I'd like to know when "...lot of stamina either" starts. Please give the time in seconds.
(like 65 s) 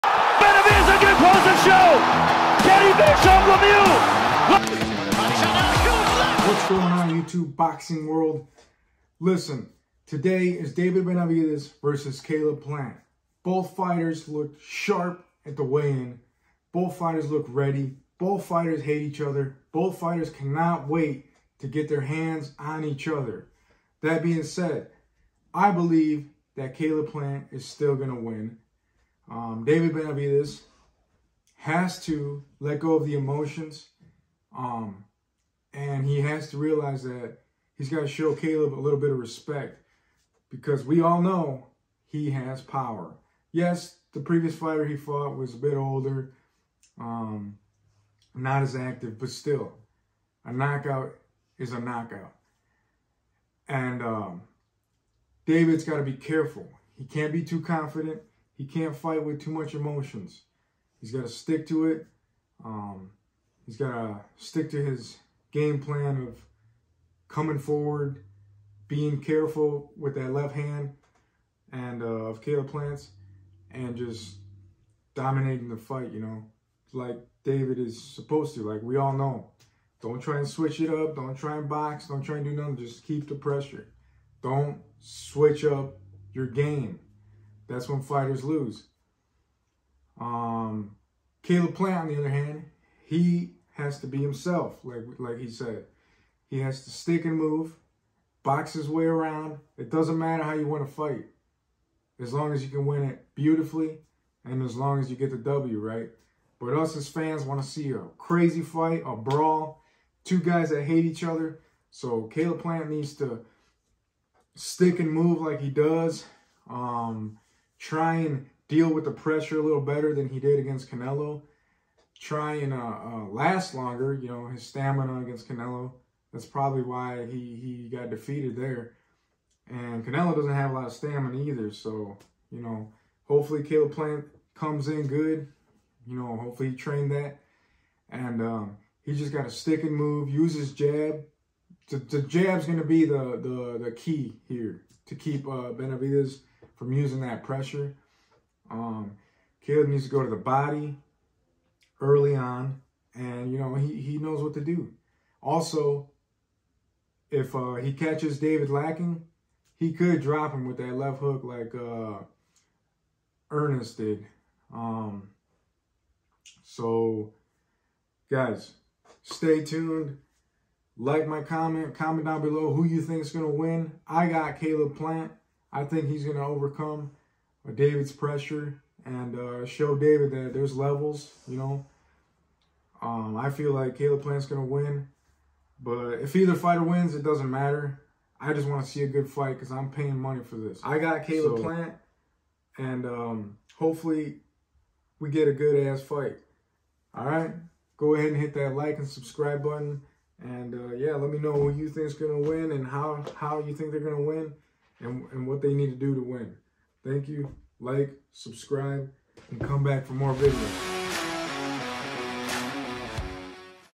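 130 s.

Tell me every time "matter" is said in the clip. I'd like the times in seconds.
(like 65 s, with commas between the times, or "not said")
100 s, 187 s.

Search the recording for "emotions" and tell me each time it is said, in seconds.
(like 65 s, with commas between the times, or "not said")
33 s, 59 s.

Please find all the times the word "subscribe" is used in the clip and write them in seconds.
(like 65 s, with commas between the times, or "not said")
199 s, 208 s.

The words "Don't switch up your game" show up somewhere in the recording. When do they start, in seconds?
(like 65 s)
84 s.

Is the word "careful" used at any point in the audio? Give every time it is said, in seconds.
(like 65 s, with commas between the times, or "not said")
56 s, 69 s.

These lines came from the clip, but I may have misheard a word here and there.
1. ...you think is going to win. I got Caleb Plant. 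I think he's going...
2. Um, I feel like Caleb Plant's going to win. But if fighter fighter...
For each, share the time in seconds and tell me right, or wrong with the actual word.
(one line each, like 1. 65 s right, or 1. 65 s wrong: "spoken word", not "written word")
1. 172 s right
2. 183 s wrong: "either", not "fighter".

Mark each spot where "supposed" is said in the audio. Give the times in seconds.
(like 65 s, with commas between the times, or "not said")
77 s.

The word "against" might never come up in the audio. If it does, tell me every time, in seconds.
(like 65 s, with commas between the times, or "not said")
120 s, 125 s.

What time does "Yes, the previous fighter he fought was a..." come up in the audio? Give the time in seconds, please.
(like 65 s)
43 s.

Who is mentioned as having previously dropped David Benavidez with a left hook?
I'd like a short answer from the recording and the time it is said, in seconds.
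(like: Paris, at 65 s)
Ernest, at 163 s.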